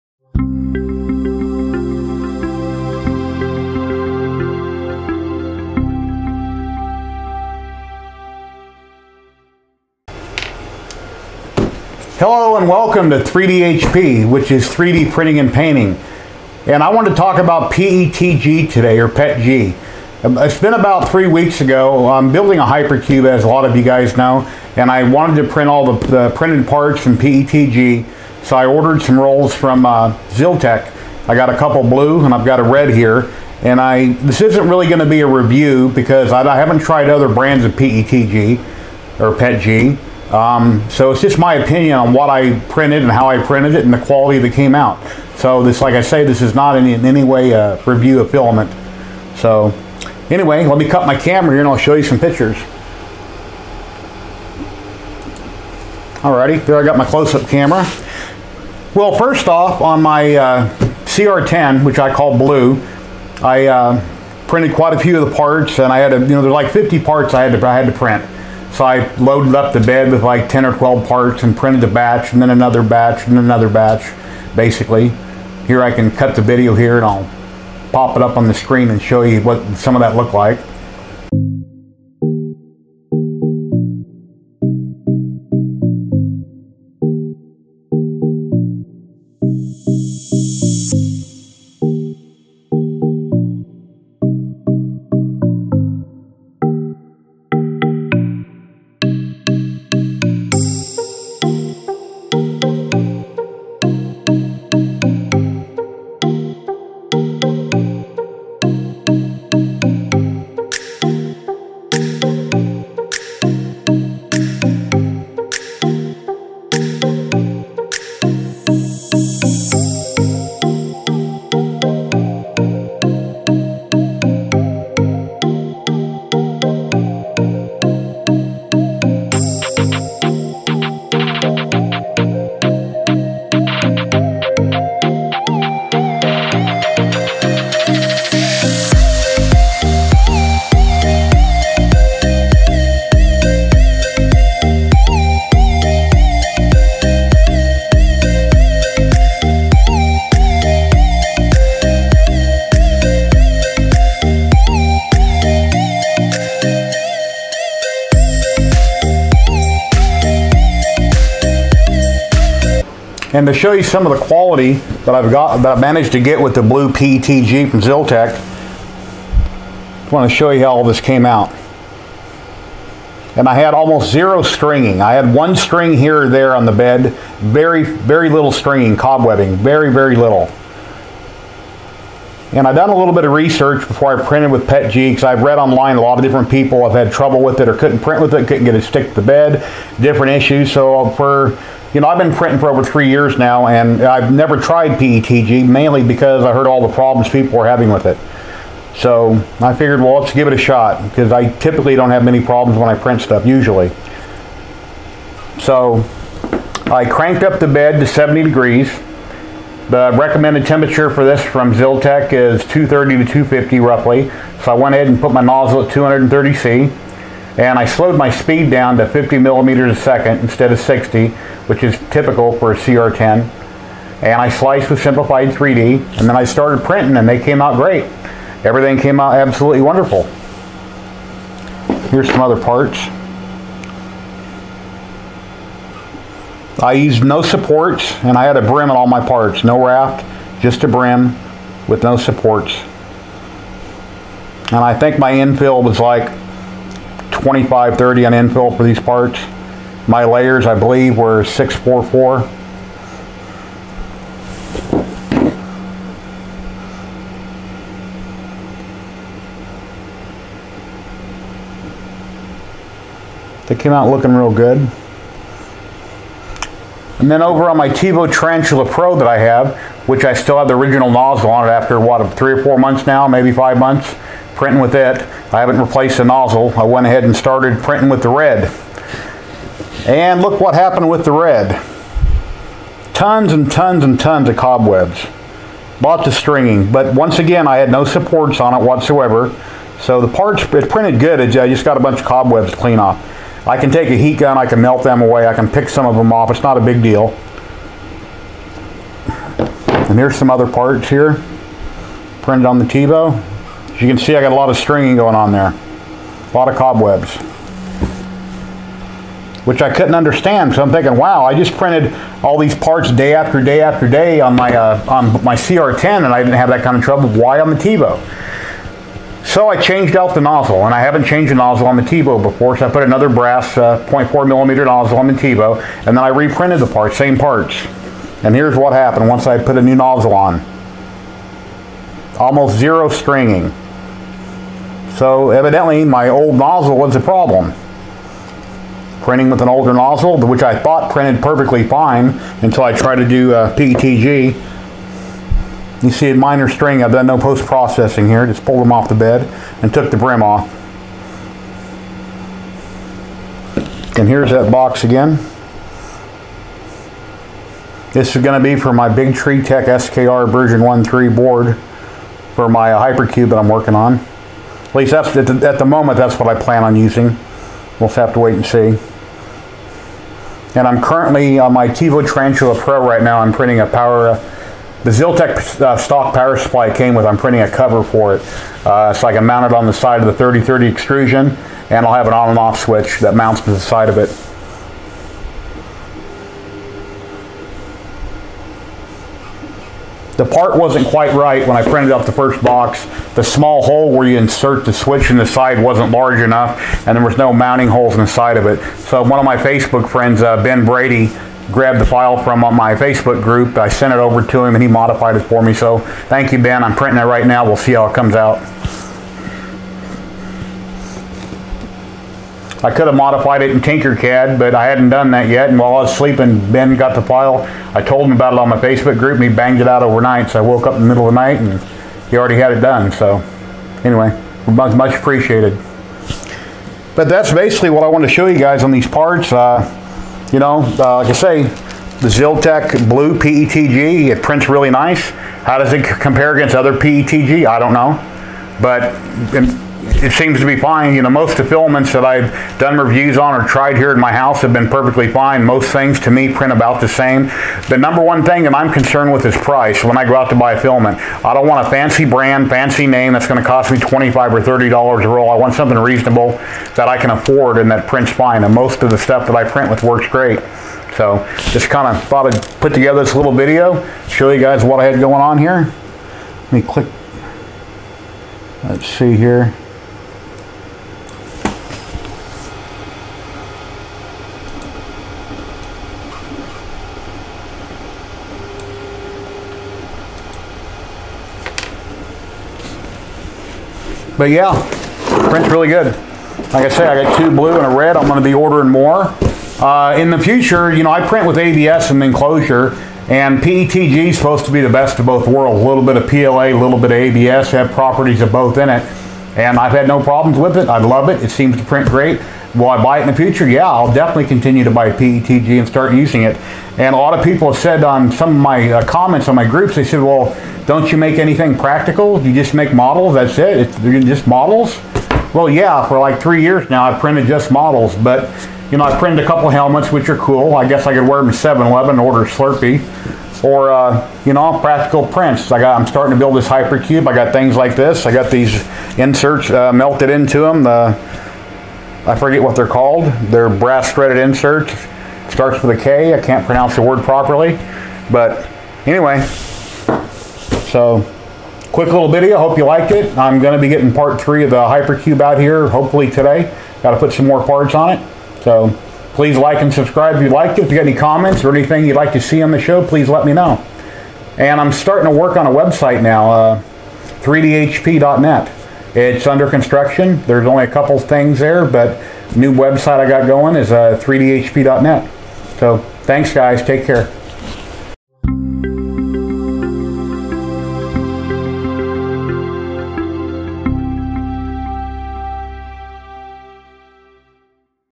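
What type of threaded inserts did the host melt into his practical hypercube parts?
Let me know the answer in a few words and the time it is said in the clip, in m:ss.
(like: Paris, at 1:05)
brass threaded inserts, at 8:53.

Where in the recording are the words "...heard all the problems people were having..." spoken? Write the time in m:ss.
3:16.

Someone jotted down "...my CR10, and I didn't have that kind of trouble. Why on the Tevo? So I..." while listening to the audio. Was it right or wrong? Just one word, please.
right.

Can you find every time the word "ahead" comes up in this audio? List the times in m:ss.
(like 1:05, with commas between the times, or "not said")
3:34, 4:37.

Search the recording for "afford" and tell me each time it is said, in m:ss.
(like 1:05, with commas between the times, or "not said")
7:37.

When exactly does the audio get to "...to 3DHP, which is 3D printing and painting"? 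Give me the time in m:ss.
0:13.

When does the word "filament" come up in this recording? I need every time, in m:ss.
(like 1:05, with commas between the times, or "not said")
0:48, 7:21, 7:30.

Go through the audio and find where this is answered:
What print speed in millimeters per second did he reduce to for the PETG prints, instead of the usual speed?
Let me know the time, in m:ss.
3:39.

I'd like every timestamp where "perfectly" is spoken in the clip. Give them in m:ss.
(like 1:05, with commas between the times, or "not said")
5:41, 7:24.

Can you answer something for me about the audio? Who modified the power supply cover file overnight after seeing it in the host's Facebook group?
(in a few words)
Ben Brady.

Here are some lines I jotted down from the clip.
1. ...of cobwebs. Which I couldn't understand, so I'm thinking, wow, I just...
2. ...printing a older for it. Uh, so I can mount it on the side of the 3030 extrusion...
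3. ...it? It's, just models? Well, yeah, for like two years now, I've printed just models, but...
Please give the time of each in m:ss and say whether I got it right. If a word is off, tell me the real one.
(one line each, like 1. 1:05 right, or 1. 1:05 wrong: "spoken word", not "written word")
1. 5:06 right
2. 6:17 wrong: "cover", not "older"
3. 8:33 wrong: "three", not "two".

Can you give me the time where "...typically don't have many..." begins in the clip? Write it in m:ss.
3:21.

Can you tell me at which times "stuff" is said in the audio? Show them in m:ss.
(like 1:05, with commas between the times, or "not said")
3:23, 7:39.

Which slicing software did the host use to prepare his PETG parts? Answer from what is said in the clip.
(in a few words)
Simplify3D.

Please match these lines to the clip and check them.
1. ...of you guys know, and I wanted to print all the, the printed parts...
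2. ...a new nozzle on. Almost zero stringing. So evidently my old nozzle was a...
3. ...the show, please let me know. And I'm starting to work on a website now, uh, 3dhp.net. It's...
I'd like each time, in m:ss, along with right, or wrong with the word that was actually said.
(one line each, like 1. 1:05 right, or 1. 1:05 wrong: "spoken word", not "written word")
1. 0:23 right
2. 5:29 right
3. 9:12 right.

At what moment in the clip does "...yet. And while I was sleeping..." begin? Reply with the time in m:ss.
6:55.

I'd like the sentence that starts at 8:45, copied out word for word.
I got, I'm starting to build this Hypercube.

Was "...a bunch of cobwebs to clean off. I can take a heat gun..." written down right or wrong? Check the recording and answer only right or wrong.
right.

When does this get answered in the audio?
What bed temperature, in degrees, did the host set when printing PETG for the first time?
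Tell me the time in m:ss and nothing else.
3:28.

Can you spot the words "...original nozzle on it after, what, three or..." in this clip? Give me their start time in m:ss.
4:30.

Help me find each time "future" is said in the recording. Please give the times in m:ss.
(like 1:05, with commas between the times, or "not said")
8:10, 8:23.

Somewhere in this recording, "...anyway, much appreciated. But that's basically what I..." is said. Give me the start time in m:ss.
7:04.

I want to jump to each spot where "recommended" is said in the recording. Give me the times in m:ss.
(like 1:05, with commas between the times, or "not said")
3:30.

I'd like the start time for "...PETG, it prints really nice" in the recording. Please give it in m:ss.
7:13.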